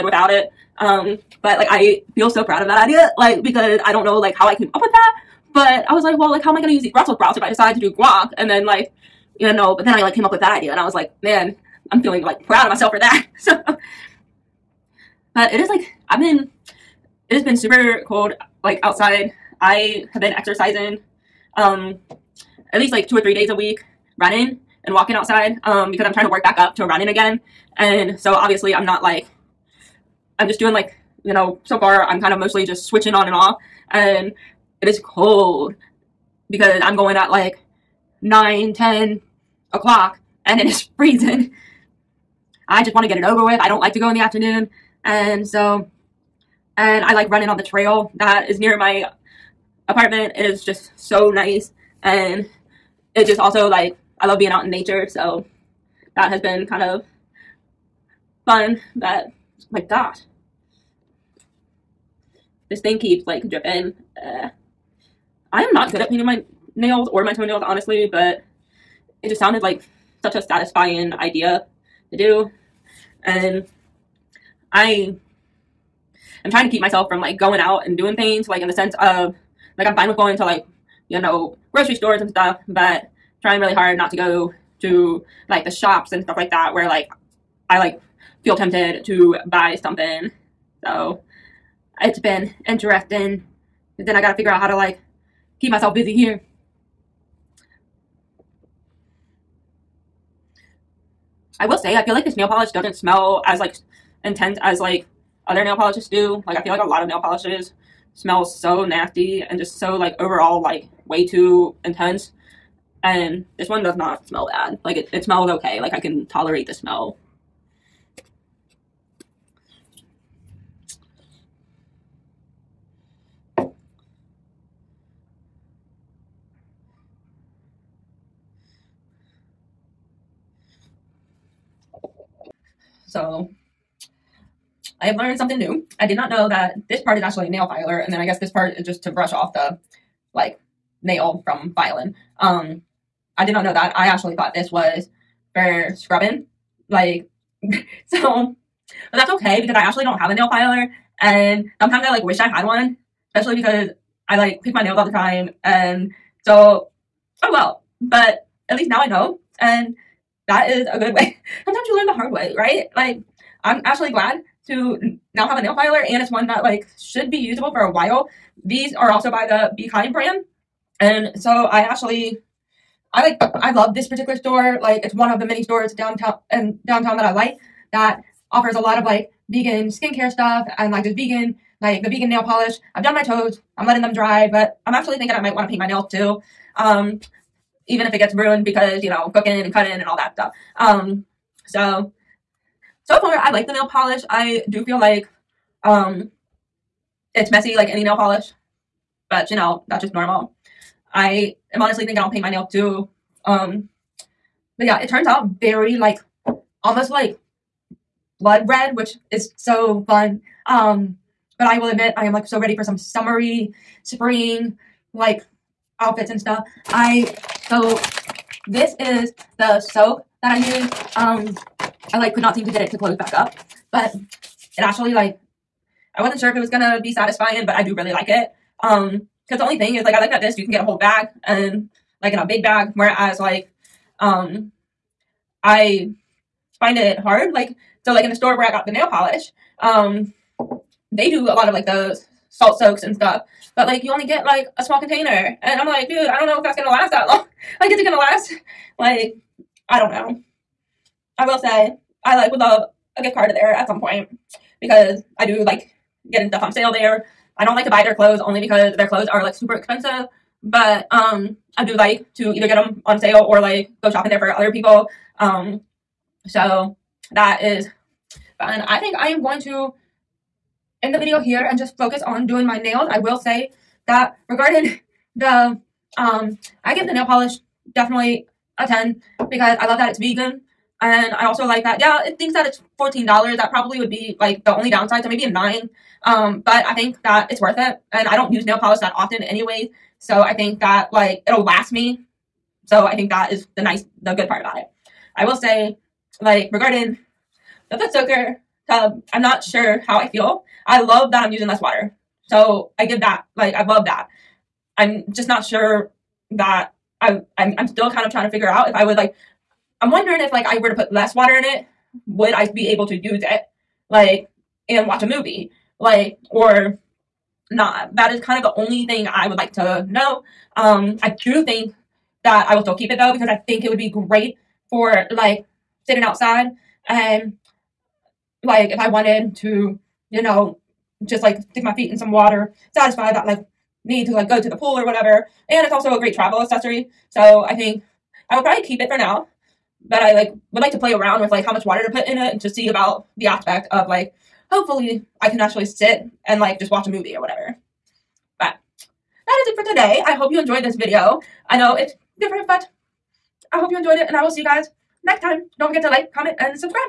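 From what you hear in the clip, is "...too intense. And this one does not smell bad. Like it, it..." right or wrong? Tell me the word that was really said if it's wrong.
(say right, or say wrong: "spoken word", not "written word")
right.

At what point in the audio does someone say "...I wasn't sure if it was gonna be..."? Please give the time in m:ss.
3:46.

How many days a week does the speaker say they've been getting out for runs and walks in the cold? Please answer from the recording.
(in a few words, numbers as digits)
two or three.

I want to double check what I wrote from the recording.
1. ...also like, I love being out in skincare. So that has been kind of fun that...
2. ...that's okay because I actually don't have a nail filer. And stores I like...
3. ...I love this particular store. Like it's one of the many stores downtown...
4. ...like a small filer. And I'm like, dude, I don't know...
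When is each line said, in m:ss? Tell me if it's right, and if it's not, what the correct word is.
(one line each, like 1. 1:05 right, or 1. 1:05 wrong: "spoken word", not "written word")
1. 0:53 wrong: "nature", not "skincare"
2. 2:29 wrong: "sometimes", not "stores"
3. 2:53 right
4. 4:04 wrong: "container", not "filer".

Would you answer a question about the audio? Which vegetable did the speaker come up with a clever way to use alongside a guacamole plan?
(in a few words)
Brussels sprouts.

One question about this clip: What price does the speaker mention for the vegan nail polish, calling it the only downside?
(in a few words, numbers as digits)
$14.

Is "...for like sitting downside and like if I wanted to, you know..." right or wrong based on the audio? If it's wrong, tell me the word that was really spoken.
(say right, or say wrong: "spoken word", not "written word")
wrong: "outside", not "downside".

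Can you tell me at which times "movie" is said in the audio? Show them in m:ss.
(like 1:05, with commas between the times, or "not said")
5:15, 5:47.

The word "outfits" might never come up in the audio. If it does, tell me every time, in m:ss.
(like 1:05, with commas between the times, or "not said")
3:36.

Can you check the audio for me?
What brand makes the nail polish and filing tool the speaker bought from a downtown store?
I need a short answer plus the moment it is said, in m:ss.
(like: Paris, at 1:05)
Be Kind, at 2:49.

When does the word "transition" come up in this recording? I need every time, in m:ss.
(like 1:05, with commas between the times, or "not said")
not said.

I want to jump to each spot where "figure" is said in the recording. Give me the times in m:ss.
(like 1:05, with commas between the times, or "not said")
1:34, 5:08.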